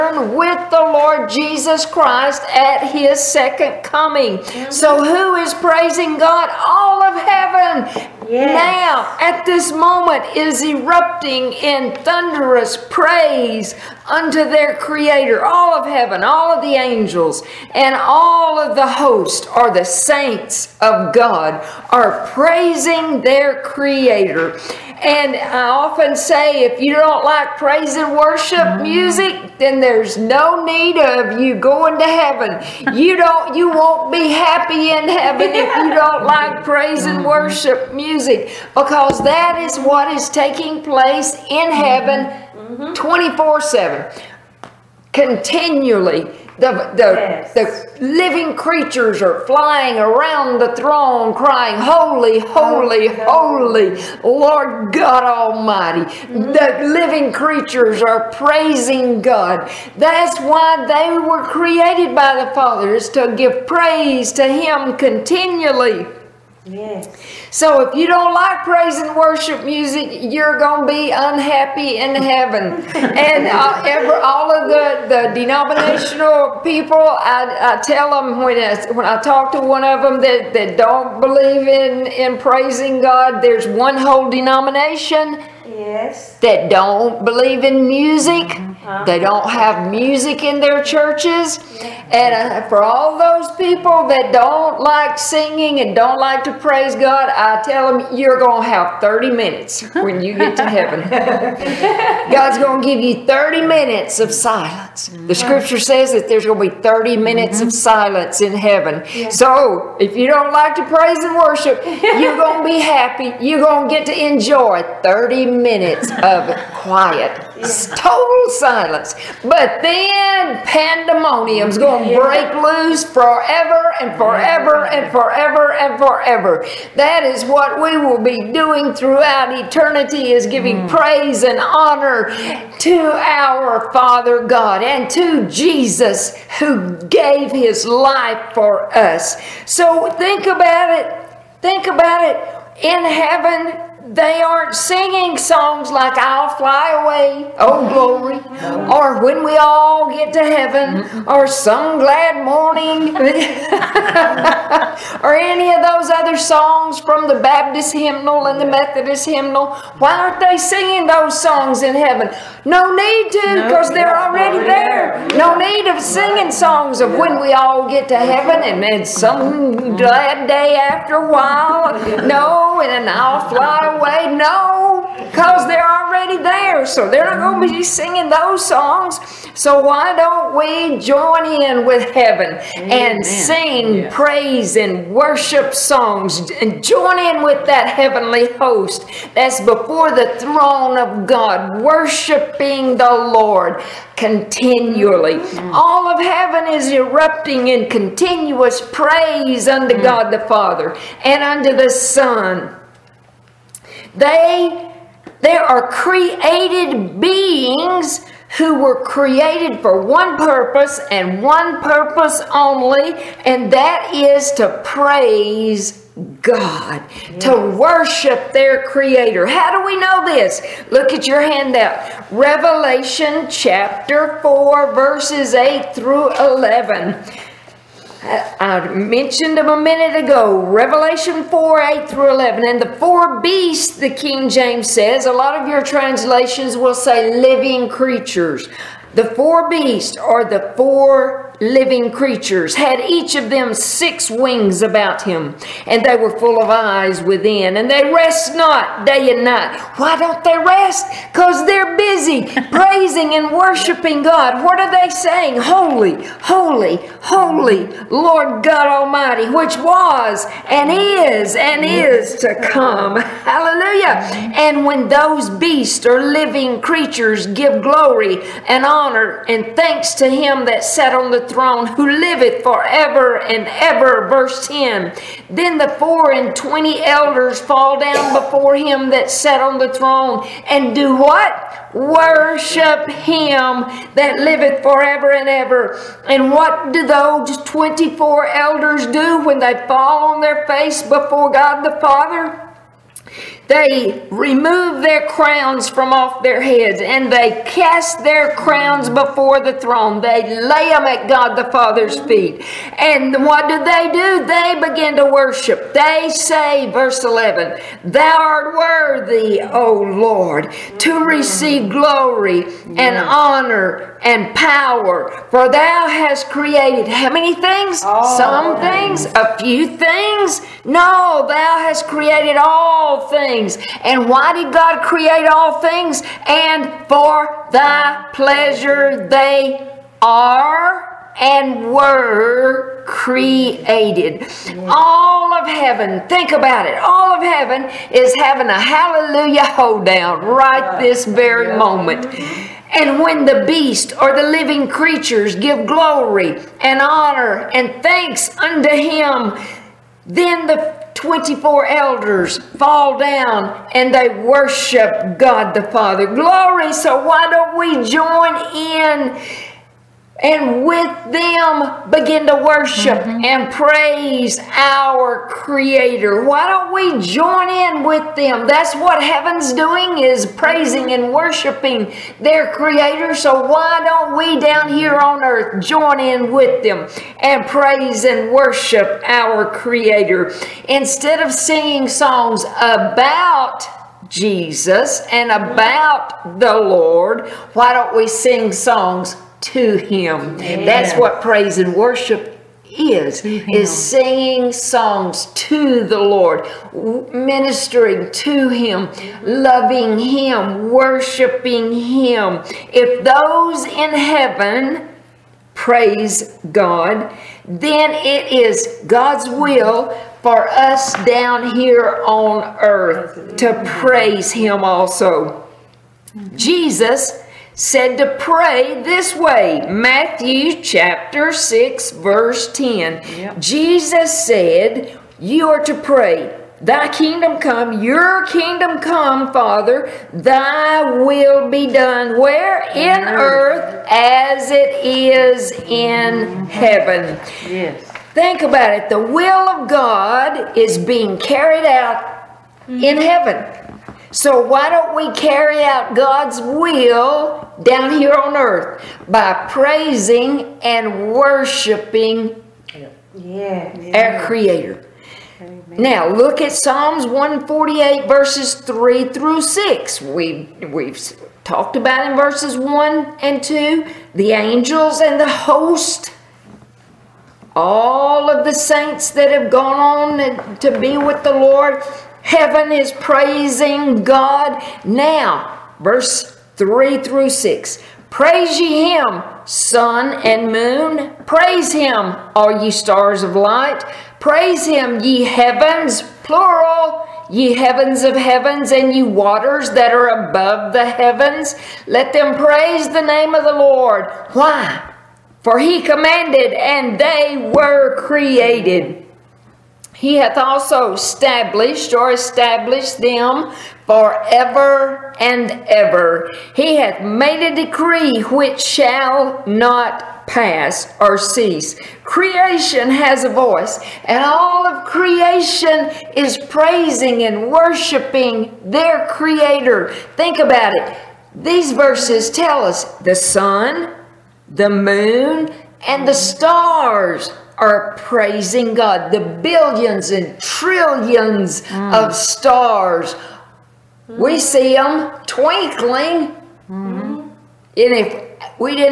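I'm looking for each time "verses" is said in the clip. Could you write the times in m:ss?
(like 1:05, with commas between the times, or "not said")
3:44, 4:34, 5:06, 7:02, 7:38, 7:42, 7:55, 8:41.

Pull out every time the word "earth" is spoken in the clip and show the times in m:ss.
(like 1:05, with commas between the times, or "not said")
6:15, 6:52, 7:13, 7:28.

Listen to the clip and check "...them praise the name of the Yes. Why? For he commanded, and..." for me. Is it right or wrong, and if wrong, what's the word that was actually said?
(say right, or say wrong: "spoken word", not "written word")
wrong: "Lord", not "Yes".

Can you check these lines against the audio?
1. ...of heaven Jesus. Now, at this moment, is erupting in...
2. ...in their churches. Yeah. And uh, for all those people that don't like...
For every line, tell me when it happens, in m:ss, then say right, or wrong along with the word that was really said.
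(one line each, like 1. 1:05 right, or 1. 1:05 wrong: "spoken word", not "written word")
1. 0:07 wrong: "Yes", not "Jesus"
2. 1:30 right.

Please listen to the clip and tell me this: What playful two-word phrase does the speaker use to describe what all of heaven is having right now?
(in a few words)
Hallelujah hoedown.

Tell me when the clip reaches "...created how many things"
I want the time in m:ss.
5:16.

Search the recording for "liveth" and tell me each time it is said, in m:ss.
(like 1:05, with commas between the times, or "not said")
4:32, 4:44.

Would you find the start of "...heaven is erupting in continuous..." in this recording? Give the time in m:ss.
3:16.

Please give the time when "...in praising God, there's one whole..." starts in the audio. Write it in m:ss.
1:22.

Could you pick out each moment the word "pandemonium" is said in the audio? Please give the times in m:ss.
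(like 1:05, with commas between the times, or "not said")
2:00.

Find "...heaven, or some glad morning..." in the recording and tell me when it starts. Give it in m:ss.
2:30.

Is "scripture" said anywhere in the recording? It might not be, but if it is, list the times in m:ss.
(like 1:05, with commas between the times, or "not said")
1:45.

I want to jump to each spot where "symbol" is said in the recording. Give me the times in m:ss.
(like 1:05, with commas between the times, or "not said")
not said.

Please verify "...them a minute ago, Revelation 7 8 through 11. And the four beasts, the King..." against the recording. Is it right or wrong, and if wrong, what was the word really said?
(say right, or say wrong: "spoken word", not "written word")
wrong: "4", not "7".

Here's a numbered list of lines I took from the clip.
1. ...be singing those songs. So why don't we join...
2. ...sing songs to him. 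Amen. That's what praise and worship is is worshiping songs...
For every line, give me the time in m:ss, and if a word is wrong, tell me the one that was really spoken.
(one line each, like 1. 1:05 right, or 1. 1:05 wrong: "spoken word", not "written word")
1. 2:57 right
2. 6:28 wrong: "singing", not "worshiping".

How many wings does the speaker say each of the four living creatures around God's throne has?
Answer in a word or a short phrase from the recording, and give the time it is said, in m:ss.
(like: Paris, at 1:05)
6, at 4:03.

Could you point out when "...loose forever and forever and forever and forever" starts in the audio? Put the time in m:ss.
2:02.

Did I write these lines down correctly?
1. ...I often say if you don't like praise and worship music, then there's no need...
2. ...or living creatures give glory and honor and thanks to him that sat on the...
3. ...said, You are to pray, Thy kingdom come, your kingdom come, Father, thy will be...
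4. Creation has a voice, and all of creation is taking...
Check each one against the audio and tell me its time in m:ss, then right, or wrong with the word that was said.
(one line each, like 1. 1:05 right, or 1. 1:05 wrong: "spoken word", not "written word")
1. 0:25 right
2. 4:26 right
3. 7:04 right
4. 8:32 wrong: "praising", not "taking".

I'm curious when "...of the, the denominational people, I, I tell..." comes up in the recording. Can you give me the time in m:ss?
1:14.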